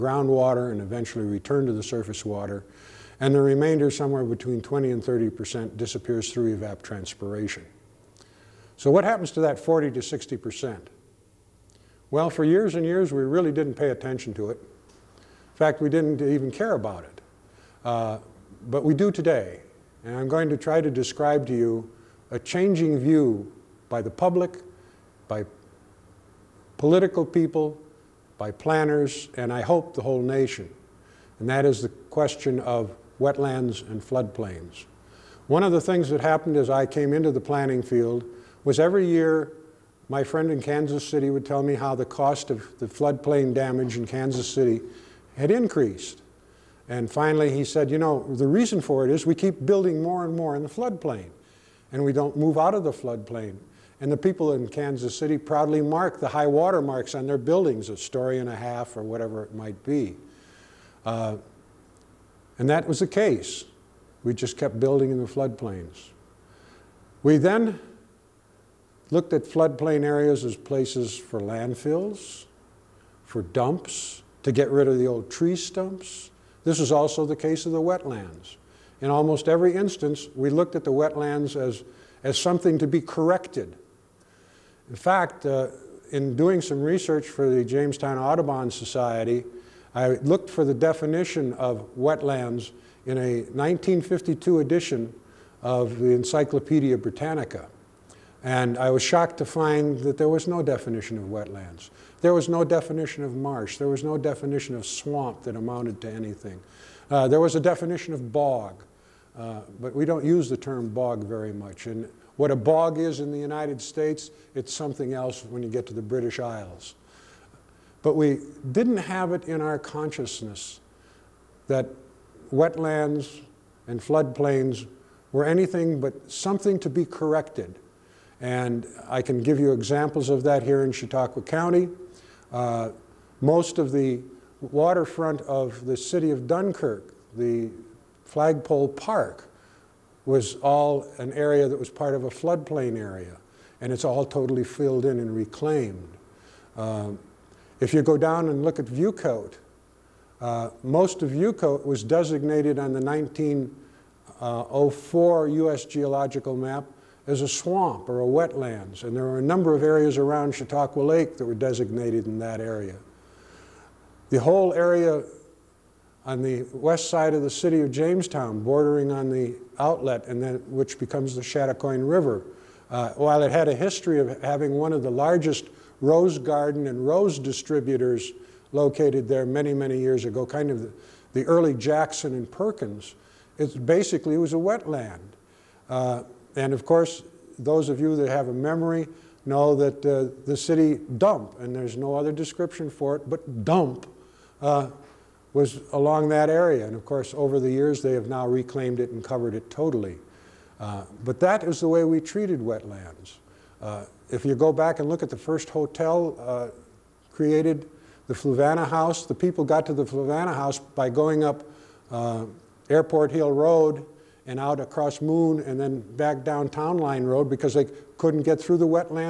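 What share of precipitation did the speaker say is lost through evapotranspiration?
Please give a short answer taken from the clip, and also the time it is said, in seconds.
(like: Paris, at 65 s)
20 to 30 percent, at 3 s.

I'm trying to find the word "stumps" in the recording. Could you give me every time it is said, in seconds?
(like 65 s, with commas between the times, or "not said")
75 s.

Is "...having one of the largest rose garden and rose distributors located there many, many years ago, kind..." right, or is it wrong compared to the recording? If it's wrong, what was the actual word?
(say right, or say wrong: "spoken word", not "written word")
right.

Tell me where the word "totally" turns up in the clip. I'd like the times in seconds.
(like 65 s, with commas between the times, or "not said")
144 s, 199 s.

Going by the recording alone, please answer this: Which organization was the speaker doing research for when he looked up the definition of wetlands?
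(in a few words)
Jamestown Audubon Society.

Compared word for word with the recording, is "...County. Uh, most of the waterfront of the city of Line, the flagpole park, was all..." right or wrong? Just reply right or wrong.
wrong.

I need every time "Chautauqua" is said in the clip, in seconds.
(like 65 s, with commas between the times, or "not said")
130 s, 160 s.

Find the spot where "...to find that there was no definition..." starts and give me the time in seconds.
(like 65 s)
99 s.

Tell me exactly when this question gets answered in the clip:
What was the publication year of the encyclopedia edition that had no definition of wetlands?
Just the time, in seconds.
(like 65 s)
93 s.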